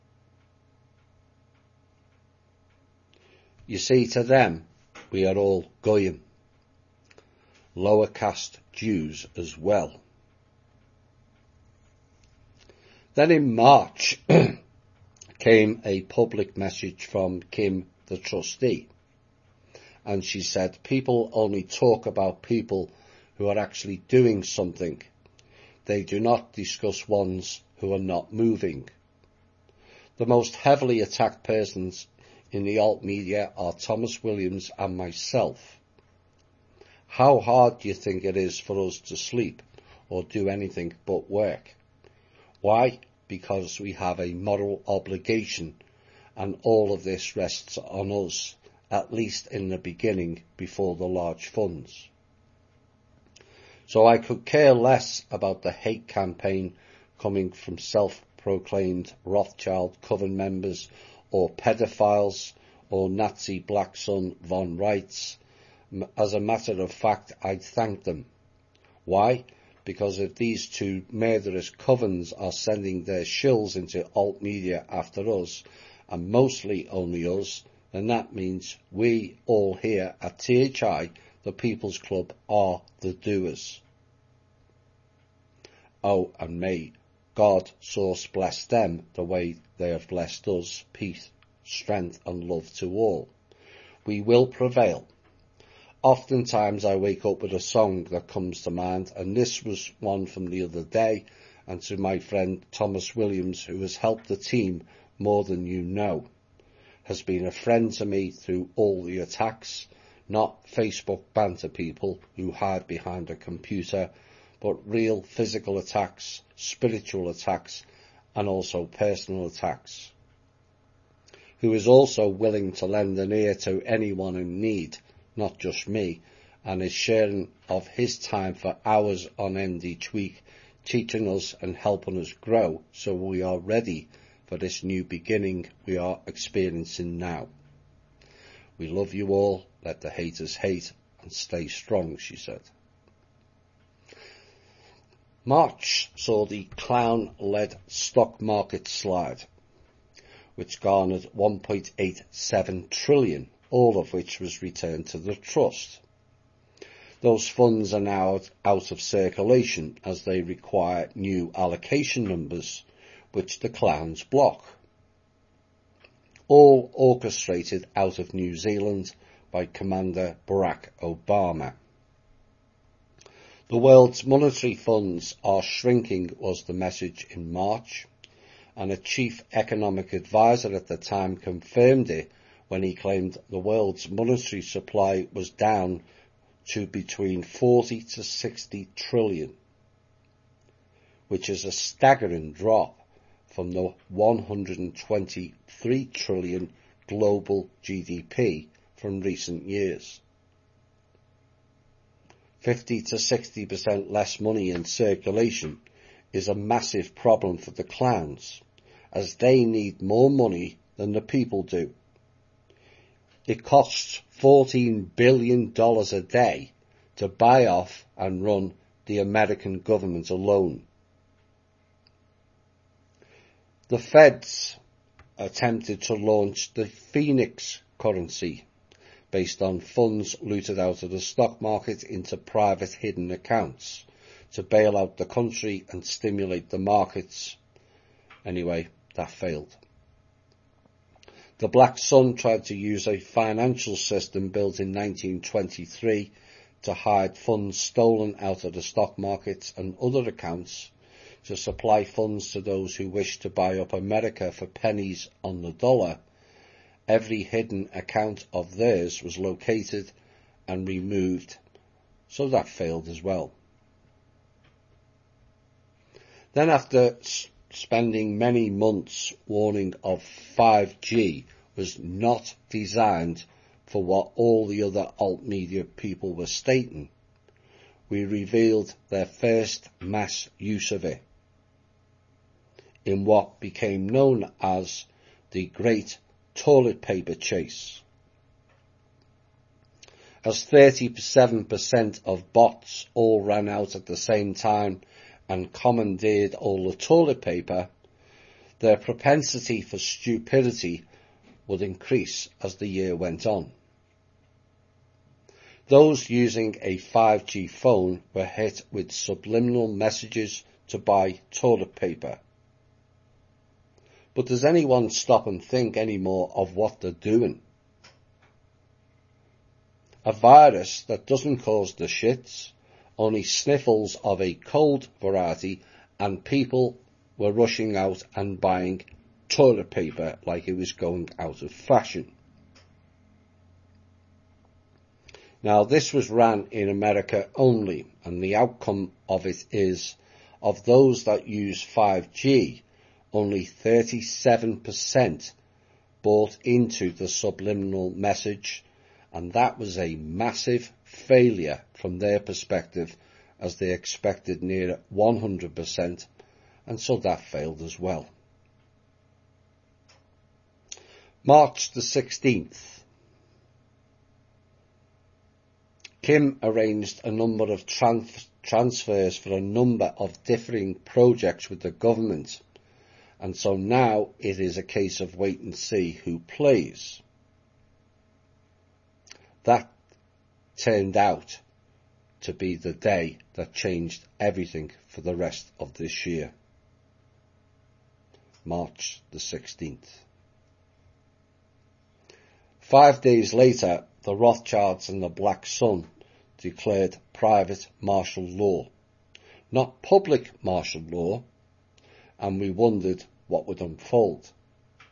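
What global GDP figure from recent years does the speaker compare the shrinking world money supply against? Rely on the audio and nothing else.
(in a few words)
123 trillion.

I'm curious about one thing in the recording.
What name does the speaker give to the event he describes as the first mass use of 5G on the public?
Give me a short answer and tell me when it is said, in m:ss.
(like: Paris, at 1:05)
Great Toilet Paper Chase, at 4:45.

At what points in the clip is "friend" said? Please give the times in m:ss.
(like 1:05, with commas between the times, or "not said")
1:42, 1:47.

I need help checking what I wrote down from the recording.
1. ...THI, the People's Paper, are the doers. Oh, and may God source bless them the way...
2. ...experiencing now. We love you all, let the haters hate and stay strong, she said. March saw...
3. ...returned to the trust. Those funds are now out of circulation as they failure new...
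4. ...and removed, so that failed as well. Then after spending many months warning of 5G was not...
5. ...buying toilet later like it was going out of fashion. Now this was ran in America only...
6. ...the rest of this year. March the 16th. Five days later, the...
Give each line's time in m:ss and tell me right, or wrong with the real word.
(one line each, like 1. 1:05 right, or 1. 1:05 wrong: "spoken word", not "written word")
1. 1:20 wrong: "Club", not "Paper"
2. 2:16 right
3. 2:34 wrong: "require", not "failure"
4. 4:20 right
5. 5:28 wrong: "paper", not "later"
6. 6:25 right.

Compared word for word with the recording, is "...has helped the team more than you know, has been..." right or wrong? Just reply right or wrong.
right.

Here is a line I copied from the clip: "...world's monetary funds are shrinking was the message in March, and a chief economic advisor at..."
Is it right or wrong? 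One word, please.
right.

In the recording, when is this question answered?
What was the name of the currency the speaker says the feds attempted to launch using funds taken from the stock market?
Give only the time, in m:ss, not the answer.
3:46.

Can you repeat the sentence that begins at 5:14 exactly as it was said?
But does anyone stop and think anymore of what they're doing?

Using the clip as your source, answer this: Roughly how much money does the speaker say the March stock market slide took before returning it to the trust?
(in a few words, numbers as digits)
1.87 trillion.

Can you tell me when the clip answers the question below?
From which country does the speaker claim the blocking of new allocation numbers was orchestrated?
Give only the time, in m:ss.
2:48.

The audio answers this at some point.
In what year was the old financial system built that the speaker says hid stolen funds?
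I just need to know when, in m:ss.
4:04.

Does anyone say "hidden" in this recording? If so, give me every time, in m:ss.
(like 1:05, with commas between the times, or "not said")
3:52, 4:17.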